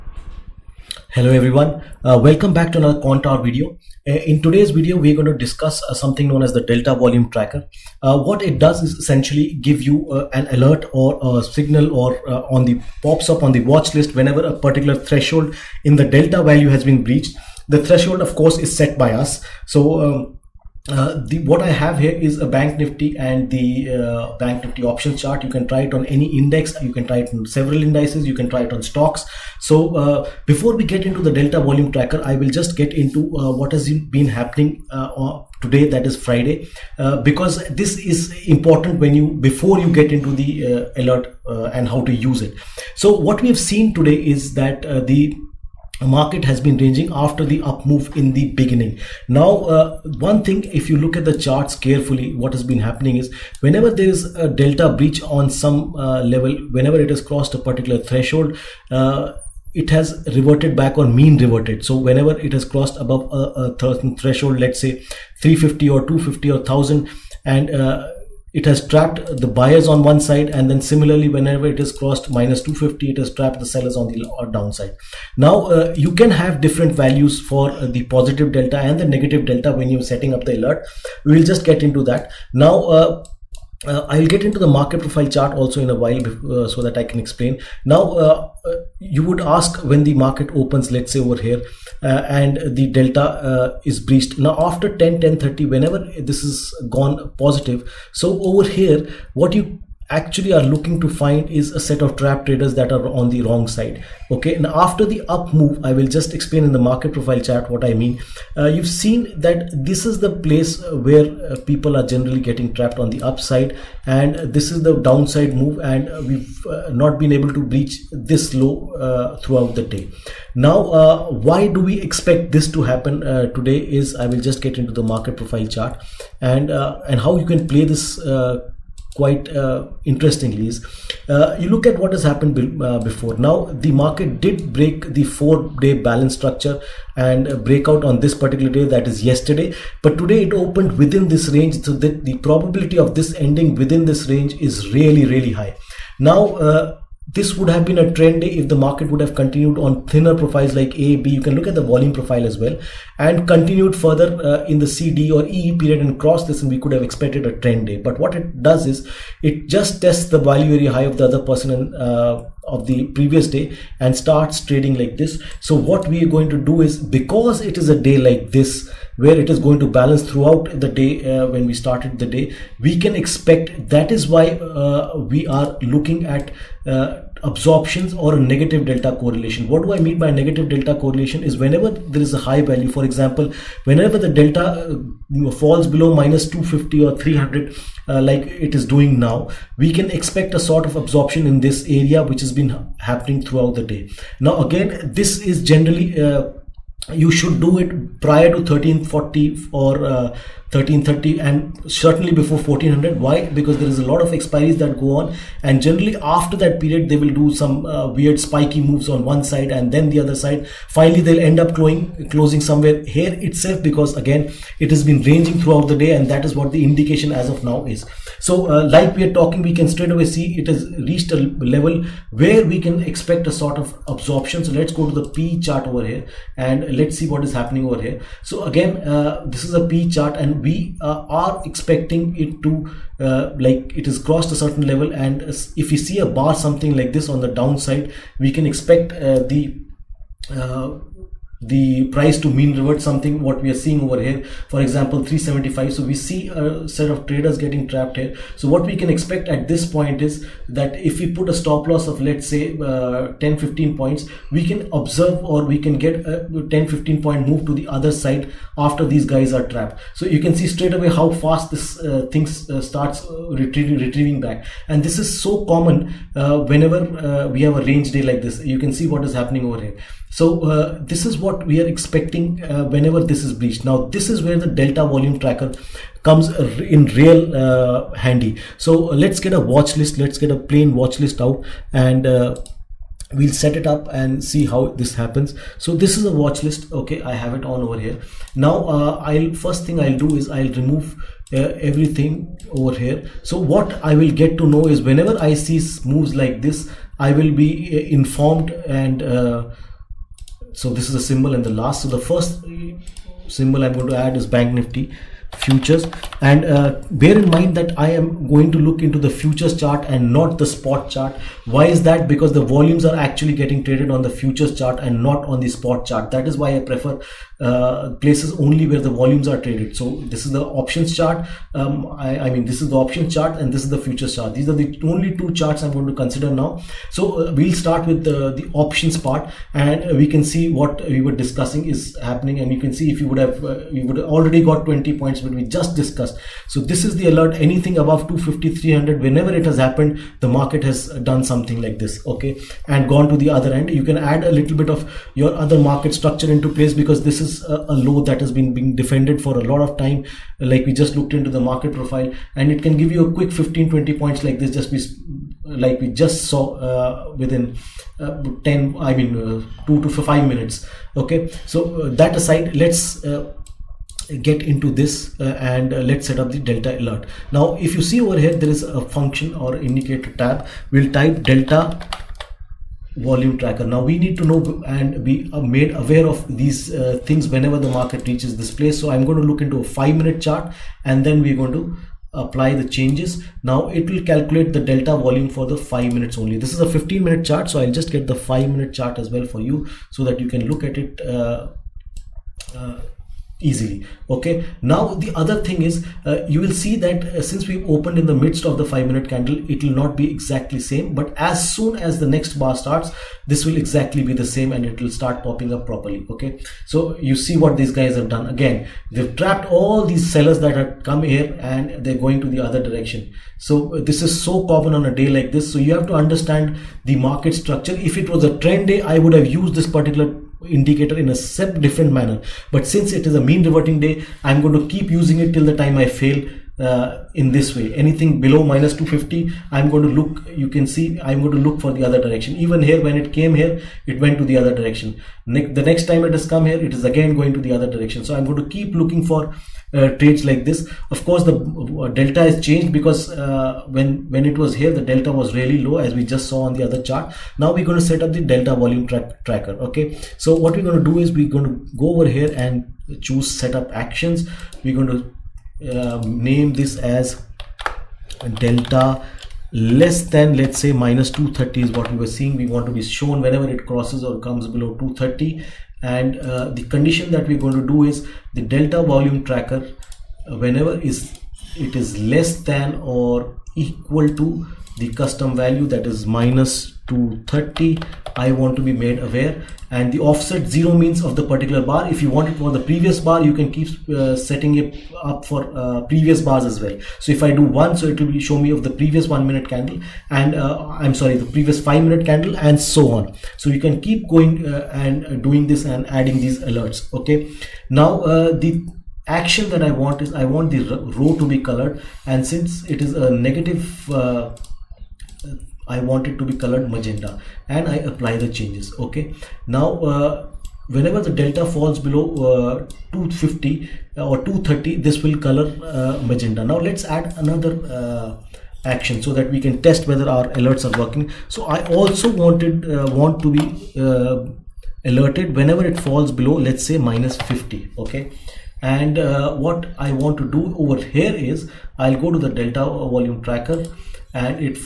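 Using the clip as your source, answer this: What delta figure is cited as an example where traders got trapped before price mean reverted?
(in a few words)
375.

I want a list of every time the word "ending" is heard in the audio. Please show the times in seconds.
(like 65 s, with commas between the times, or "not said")
143 s.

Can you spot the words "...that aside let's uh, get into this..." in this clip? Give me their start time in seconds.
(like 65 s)
362 s.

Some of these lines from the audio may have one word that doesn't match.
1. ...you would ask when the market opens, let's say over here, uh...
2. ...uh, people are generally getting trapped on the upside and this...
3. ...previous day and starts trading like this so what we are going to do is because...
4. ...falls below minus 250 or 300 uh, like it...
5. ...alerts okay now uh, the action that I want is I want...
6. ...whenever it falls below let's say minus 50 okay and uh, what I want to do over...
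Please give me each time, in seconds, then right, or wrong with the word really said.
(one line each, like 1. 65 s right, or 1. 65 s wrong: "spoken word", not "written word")
1. 88 s right
2. 111 s right
3. 163 s right
4. 185 s right
5. 496 s right
6. 525 s right.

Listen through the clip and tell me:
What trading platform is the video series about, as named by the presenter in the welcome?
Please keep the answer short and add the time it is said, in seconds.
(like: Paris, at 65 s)
Quantower, at 2 s.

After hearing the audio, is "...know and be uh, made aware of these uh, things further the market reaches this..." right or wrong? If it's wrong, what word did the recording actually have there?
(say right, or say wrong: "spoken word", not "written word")
wrong: "whenever", not "further".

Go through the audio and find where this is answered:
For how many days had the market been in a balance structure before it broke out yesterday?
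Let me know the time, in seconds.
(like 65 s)
135 s.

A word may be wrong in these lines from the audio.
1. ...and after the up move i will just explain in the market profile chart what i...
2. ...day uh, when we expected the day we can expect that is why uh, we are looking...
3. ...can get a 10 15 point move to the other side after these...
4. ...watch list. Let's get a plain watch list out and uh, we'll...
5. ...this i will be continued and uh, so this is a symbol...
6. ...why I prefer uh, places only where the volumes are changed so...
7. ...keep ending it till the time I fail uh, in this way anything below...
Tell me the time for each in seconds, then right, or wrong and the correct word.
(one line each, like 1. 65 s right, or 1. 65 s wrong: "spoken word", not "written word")
1. 104 s right
2. 170 s wrong: "started", not "expected"
3. 255 s right
4. 279 s right
5. 296 s wrong: "informed", not "continued"
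6. 316 s wrong: "traded", not "changed"
7. 424 s wrong: "using", not "ending".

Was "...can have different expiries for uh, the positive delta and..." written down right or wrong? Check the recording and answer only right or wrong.
wrong.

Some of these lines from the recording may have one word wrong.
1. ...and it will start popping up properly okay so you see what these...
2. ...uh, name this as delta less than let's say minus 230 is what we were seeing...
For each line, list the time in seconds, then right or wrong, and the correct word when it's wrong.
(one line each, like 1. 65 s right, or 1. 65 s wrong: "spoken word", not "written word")
1. 404 s right
2. 455 s right.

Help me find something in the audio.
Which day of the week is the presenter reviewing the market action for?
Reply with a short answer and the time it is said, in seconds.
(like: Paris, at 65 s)
Friday, at 36 s.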